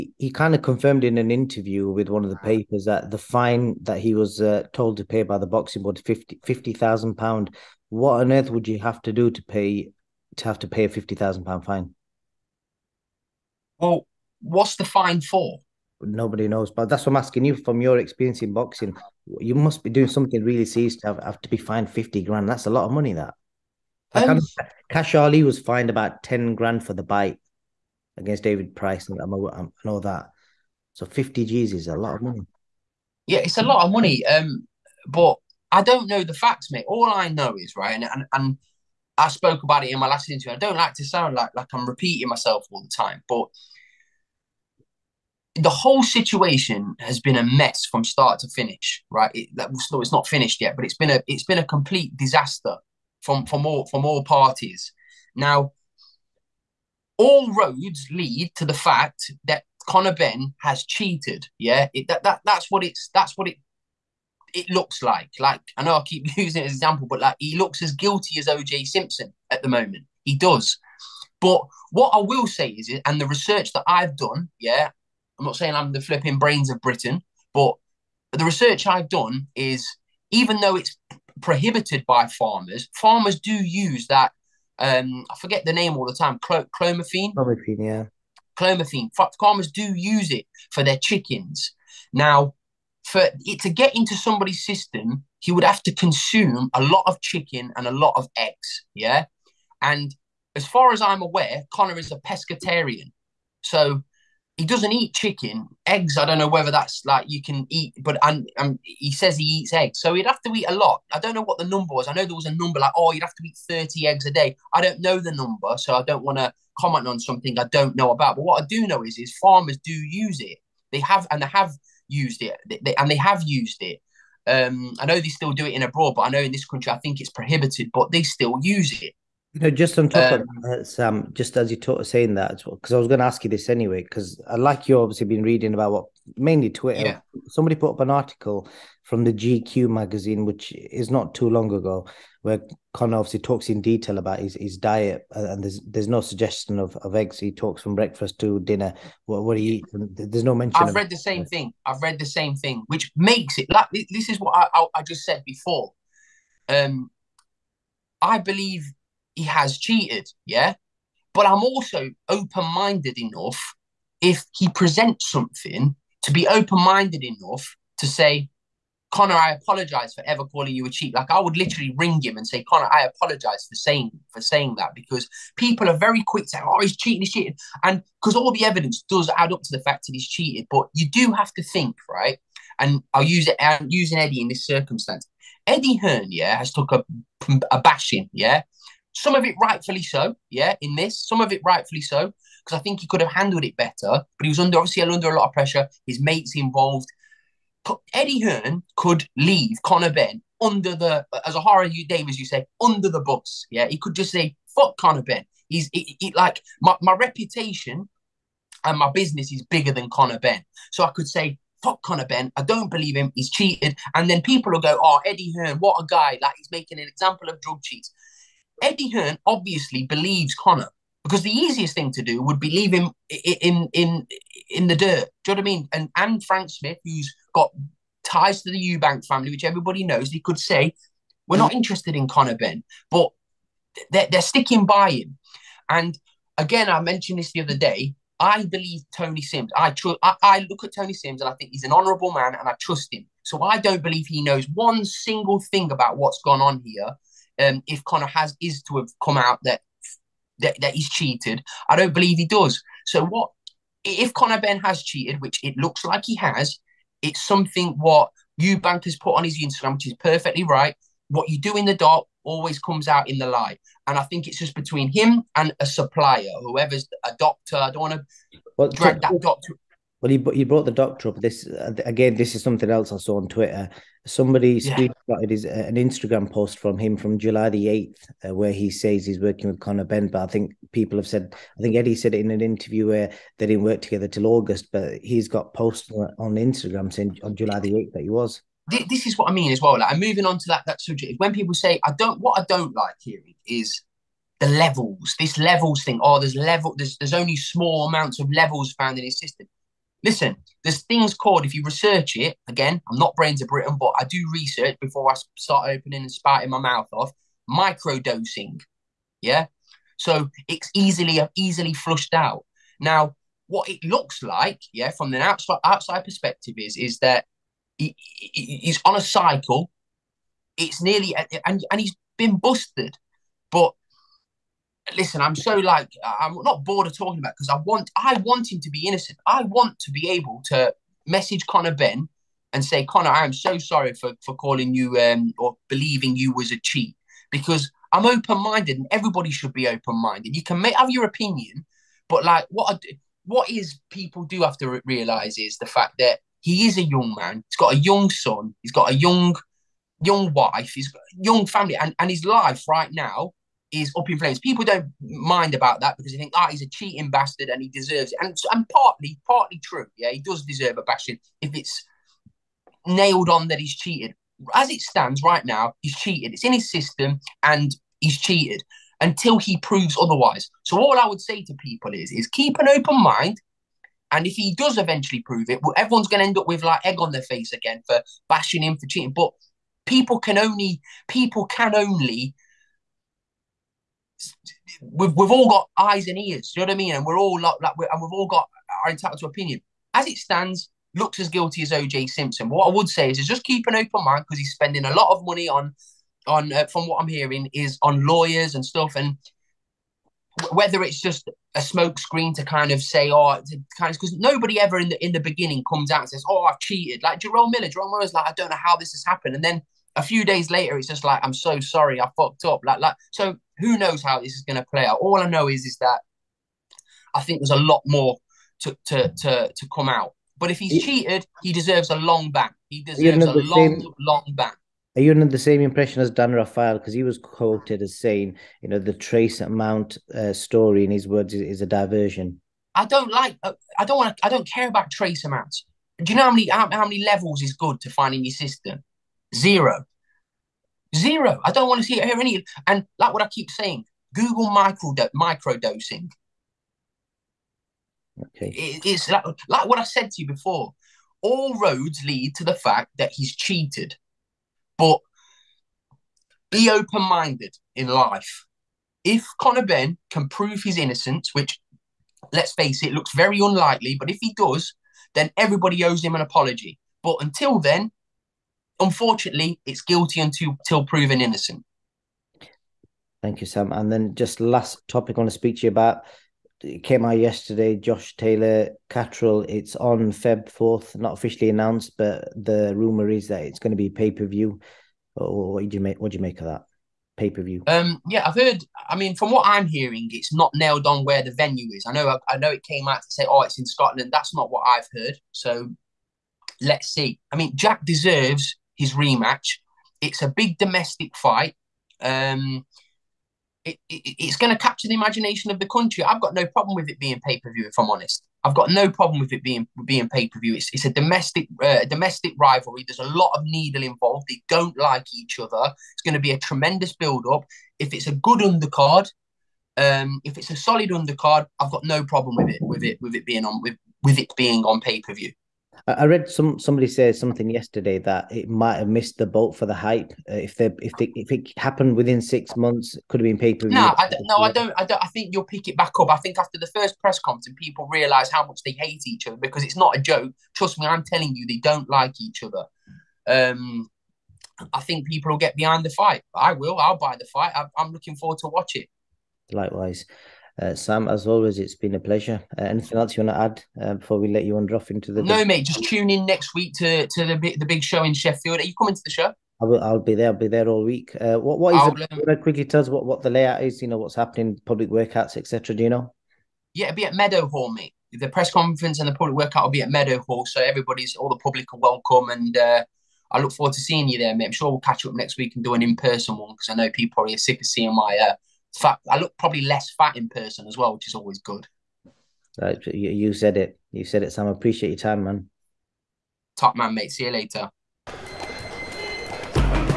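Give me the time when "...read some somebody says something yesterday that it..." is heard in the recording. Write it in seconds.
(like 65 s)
526 s.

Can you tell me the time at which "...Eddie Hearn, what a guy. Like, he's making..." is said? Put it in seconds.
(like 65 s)
215 s.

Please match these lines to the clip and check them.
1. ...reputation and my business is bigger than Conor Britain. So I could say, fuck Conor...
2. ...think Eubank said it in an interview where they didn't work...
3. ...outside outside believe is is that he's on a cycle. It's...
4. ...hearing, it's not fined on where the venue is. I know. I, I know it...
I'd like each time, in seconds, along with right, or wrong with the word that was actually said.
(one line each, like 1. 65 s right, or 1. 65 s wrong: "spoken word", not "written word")
1. 207 s wrong: "Benn", not "Britain"
2. 281 s wrong: "Eddie", not "Eubank"
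3. 315 s wrong: "perspective", not "believe"
4. 489 s wrong: "nailed", not "fined".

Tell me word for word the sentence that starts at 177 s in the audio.
And because all the evidence does add up to the fact that he's cheated, but you do have to think, right?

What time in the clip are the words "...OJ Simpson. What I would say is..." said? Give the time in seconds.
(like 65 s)
391 s.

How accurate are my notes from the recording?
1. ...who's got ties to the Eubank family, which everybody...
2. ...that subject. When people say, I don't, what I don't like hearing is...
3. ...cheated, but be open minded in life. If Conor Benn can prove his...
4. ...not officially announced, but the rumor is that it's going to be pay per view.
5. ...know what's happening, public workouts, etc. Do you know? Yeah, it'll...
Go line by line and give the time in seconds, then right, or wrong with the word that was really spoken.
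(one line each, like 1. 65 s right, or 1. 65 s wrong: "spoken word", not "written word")
1. 227 s right
2. 290 s right
3. 453 s right
4. 481 s right
5. 564 s right.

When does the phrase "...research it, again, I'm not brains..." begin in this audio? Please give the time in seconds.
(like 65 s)
301 s.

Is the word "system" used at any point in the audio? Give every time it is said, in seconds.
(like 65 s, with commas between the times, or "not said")
94 s, 299 s, 366 s, 438 s.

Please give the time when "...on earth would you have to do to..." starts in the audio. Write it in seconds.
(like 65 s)
8 s.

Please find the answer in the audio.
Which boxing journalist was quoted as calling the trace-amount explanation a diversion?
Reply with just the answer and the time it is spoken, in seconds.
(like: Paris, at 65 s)
Dan Rafael, at 426 s.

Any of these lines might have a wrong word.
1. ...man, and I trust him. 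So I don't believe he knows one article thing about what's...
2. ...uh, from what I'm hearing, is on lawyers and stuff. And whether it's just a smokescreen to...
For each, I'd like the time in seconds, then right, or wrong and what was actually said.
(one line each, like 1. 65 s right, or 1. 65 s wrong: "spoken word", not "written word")
1. 242 s wrong: "single", not "article"
2. 396 s right.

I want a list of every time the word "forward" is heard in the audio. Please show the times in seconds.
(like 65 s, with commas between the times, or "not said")
548 s, 573 s.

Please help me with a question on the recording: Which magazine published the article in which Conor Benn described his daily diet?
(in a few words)
GQ.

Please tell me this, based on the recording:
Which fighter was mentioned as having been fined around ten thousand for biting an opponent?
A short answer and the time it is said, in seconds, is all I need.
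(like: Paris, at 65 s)
Kash Ali, at 24 s.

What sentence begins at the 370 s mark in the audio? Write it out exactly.
So all I would say to people is, is keep an open mind.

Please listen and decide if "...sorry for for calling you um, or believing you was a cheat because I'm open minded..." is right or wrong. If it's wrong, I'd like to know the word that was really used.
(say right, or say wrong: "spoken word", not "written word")
right.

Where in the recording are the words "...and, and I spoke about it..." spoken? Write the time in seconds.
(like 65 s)
38 s.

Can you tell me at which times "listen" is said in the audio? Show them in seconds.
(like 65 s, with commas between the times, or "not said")
300 s, 325 s.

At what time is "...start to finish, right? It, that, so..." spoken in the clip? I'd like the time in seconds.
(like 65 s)
48 s.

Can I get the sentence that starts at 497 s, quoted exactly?
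I mean, Jack deserves his rematch.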